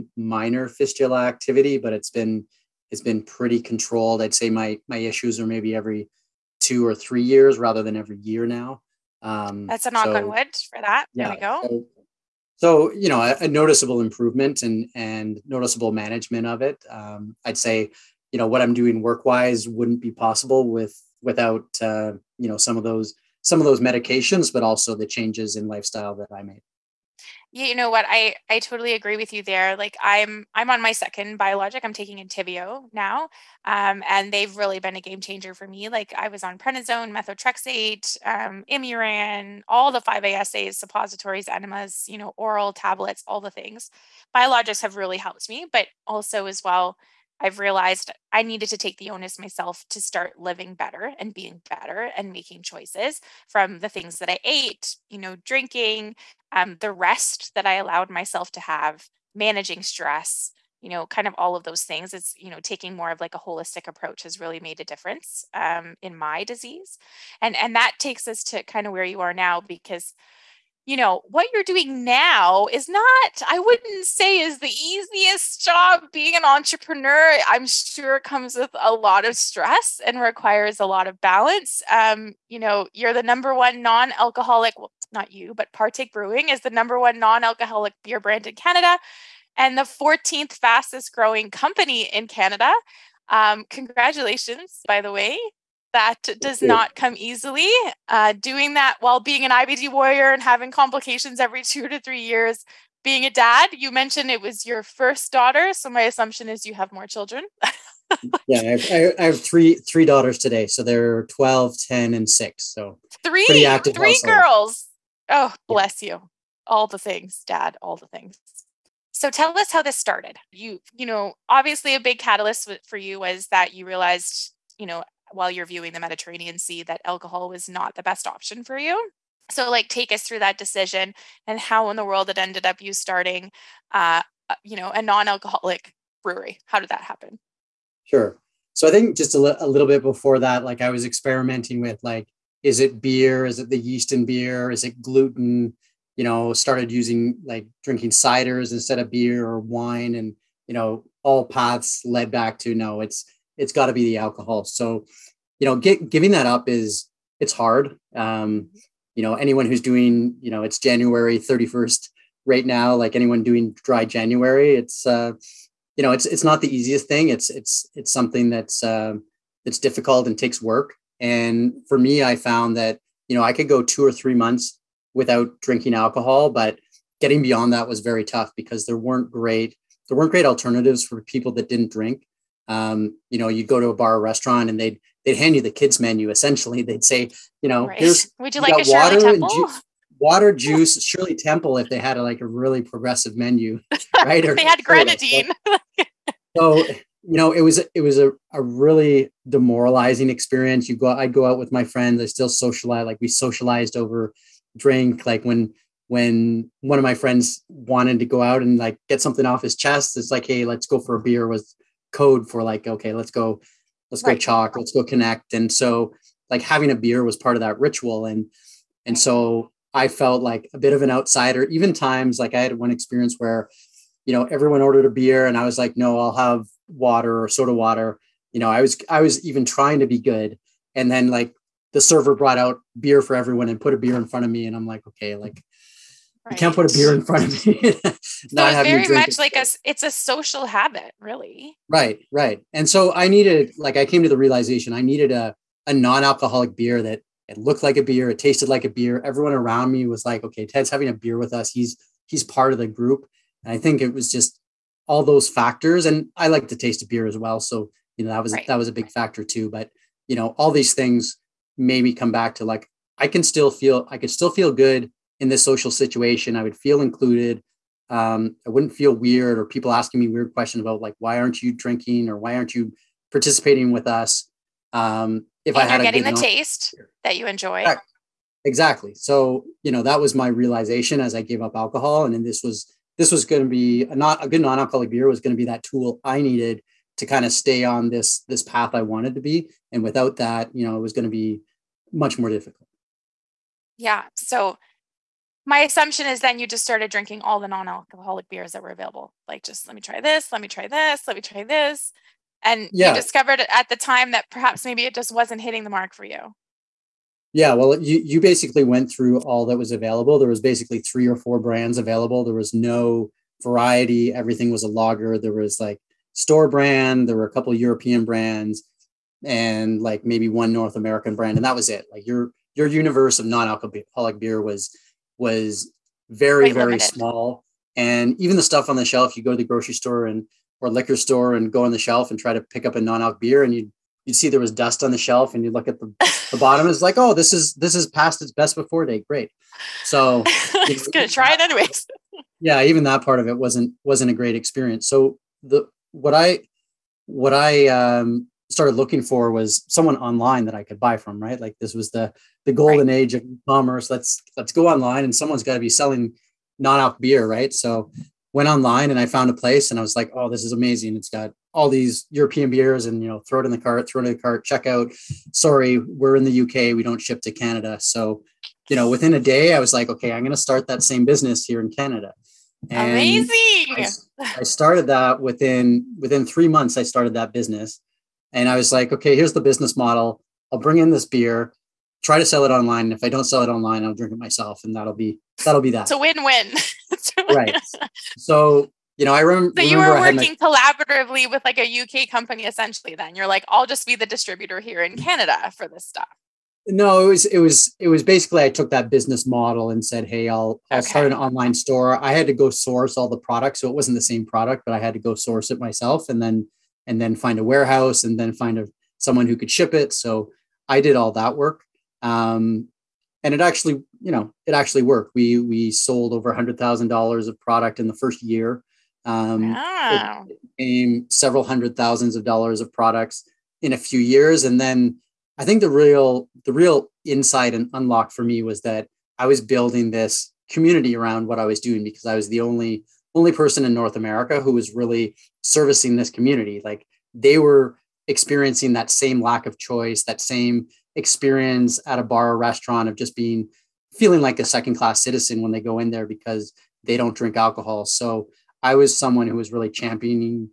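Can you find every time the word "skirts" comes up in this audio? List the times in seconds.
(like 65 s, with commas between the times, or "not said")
not said.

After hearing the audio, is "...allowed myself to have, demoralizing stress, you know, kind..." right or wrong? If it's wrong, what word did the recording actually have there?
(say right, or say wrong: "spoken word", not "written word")
wrong: "managing", not "demoralizing".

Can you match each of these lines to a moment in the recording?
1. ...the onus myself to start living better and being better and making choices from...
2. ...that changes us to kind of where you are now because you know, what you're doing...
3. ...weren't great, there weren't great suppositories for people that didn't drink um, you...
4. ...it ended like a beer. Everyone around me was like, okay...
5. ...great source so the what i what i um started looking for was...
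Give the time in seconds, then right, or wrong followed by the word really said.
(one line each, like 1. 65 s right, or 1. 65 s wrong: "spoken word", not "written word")
1. 48 s right
2. 67 s wrong: "takes", not "changes"
3. 178 s wrong: "alternatives", not "suppositories"
4. 248 s wrong: "tasted", not "ended"
5. 344 s wrong: "experience", not "source".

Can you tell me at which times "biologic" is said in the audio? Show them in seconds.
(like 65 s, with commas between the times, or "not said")
31 s, 44 s.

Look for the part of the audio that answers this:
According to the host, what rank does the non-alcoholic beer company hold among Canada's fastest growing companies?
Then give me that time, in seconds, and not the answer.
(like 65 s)
89 s.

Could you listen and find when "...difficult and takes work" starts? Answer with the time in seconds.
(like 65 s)
169 s.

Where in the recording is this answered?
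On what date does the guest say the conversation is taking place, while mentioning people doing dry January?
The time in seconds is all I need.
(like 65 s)
160 s.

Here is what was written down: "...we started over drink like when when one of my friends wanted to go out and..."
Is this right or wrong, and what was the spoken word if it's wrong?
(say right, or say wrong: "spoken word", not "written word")
wrong: "socialized", not "started".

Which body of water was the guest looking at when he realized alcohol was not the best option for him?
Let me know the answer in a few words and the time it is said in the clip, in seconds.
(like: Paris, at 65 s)
Mediterranean Sea, at 125 s.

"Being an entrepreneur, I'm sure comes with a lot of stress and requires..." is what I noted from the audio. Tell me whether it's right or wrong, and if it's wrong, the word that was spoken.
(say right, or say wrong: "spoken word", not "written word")
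right.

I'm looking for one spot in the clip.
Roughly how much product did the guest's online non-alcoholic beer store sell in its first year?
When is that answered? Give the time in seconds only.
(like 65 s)
416 s.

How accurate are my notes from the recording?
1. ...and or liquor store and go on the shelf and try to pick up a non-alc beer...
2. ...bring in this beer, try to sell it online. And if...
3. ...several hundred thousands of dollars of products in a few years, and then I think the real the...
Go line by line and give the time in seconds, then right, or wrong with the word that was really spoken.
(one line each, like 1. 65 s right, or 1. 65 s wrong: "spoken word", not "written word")
1. 330 s right
2. 380 s right
3. 421 s right.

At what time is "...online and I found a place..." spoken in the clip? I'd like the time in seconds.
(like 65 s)
358 s.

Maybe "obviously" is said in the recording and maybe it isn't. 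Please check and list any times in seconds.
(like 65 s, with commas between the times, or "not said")
121 s.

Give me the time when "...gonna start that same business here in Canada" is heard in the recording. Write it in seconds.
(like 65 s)
370 s.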